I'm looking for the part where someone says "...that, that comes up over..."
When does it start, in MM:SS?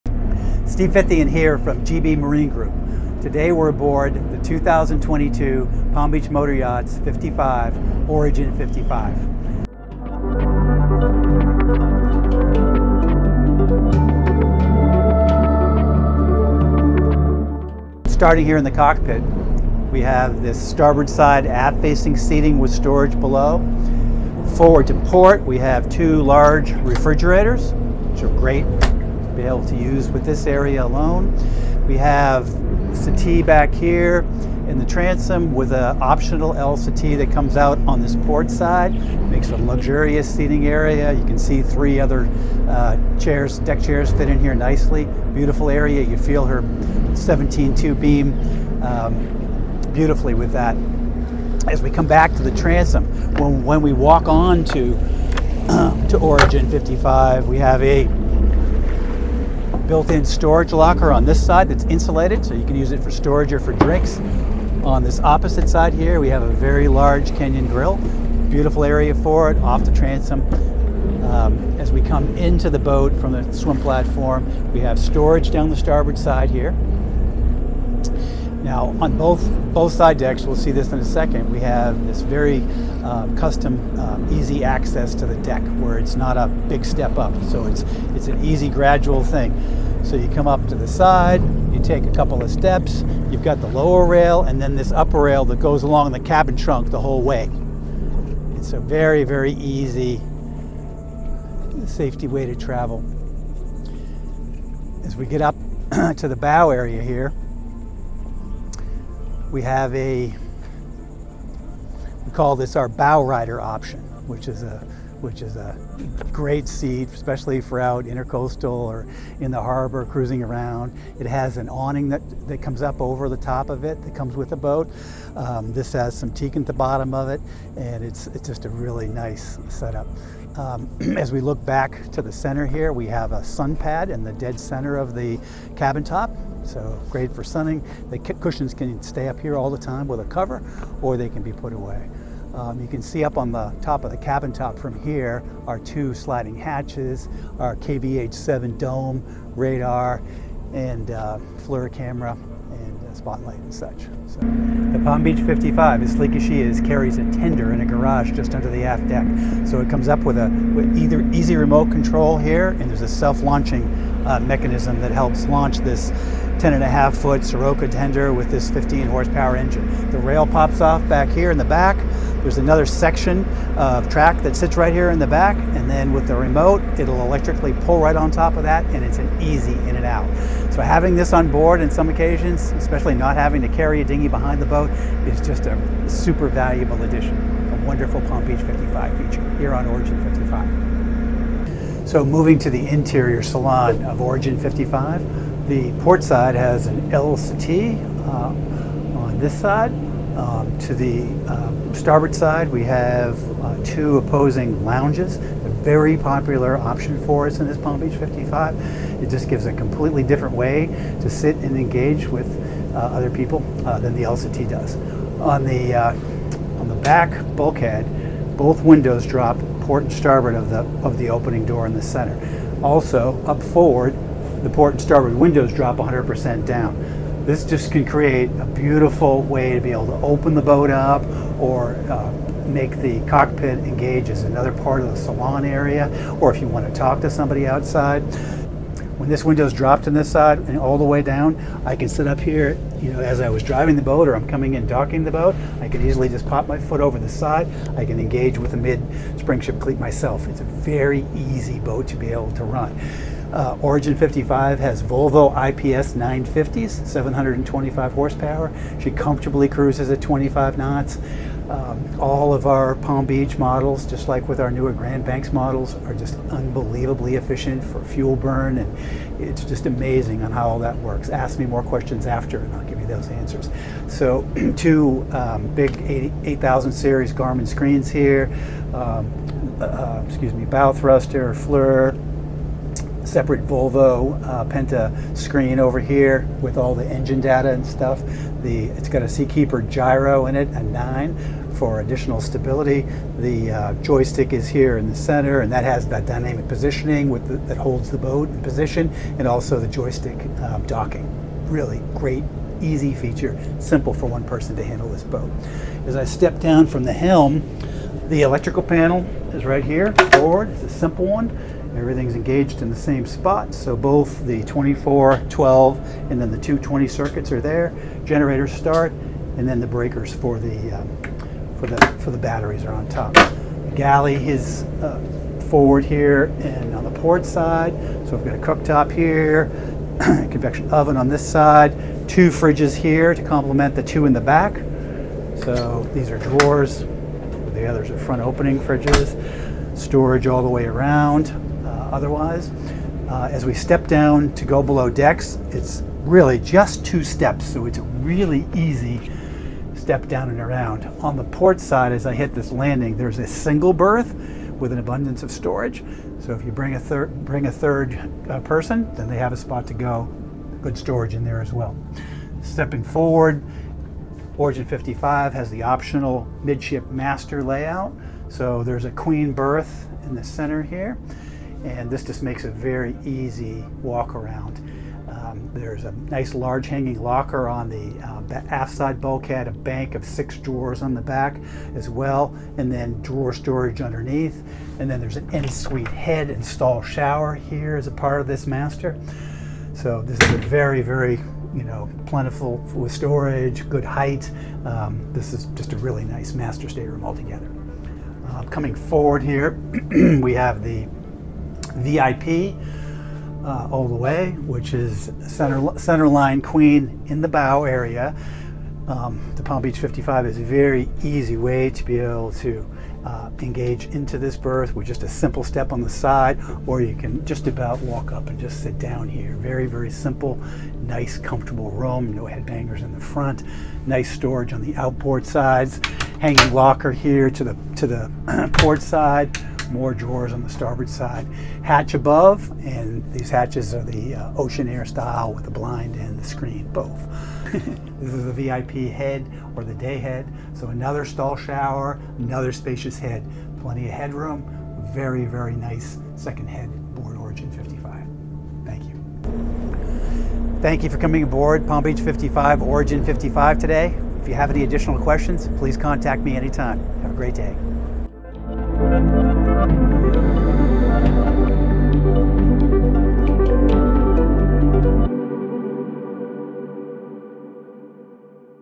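02:02.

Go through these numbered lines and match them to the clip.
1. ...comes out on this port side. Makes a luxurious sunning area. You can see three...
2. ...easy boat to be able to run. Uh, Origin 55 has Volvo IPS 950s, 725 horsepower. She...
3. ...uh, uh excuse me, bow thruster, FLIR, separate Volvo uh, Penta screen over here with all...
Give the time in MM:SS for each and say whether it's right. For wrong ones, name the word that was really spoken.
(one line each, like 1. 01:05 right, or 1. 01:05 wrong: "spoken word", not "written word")
1. 00:37 wrong: "seating", not "sunning"
2. 04:11 right
3. 04:39 right.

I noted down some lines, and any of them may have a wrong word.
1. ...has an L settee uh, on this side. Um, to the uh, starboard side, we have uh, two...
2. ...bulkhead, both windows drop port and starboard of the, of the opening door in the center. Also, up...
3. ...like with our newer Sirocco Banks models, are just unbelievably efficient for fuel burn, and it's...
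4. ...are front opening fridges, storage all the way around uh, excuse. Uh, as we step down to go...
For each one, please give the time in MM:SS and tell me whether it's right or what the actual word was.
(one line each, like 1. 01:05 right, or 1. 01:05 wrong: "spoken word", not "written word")
1. 03:16 right
2. 03:37 right
3. 04:24 wrong: "Grand", not "Sirocco"
4. 05:38 wrong: "otherwise", not "excuse".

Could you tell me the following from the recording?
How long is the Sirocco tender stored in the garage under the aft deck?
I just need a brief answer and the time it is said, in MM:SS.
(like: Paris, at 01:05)
10 and a half foot, at 02:46.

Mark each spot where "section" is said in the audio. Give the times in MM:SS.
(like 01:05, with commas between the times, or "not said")
02:52.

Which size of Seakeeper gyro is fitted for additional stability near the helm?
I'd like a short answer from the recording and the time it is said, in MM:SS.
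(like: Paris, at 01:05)
9, at 04:50.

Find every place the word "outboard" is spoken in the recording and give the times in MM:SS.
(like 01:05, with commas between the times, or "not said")
07:04.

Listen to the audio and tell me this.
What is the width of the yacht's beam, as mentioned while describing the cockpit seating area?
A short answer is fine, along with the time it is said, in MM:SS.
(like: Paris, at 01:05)
17-2, at 00:46.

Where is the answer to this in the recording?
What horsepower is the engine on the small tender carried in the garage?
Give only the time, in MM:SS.
02:48.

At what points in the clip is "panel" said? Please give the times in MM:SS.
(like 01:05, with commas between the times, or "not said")
05:08.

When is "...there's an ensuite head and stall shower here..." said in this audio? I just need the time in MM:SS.
06:25.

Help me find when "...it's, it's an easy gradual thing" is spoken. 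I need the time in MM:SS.
01:27.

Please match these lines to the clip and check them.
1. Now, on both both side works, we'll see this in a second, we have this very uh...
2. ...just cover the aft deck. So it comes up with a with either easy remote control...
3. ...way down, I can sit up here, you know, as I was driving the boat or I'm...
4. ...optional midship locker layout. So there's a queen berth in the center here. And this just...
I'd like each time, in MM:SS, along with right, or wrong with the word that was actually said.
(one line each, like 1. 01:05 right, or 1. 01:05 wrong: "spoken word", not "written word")
1. 01:18 wrong: "decks", not "works"
2. 02:38 wrong: "under", not "cover"
3. 04:01 right
4. 06:05 wrong: "master", not "locker".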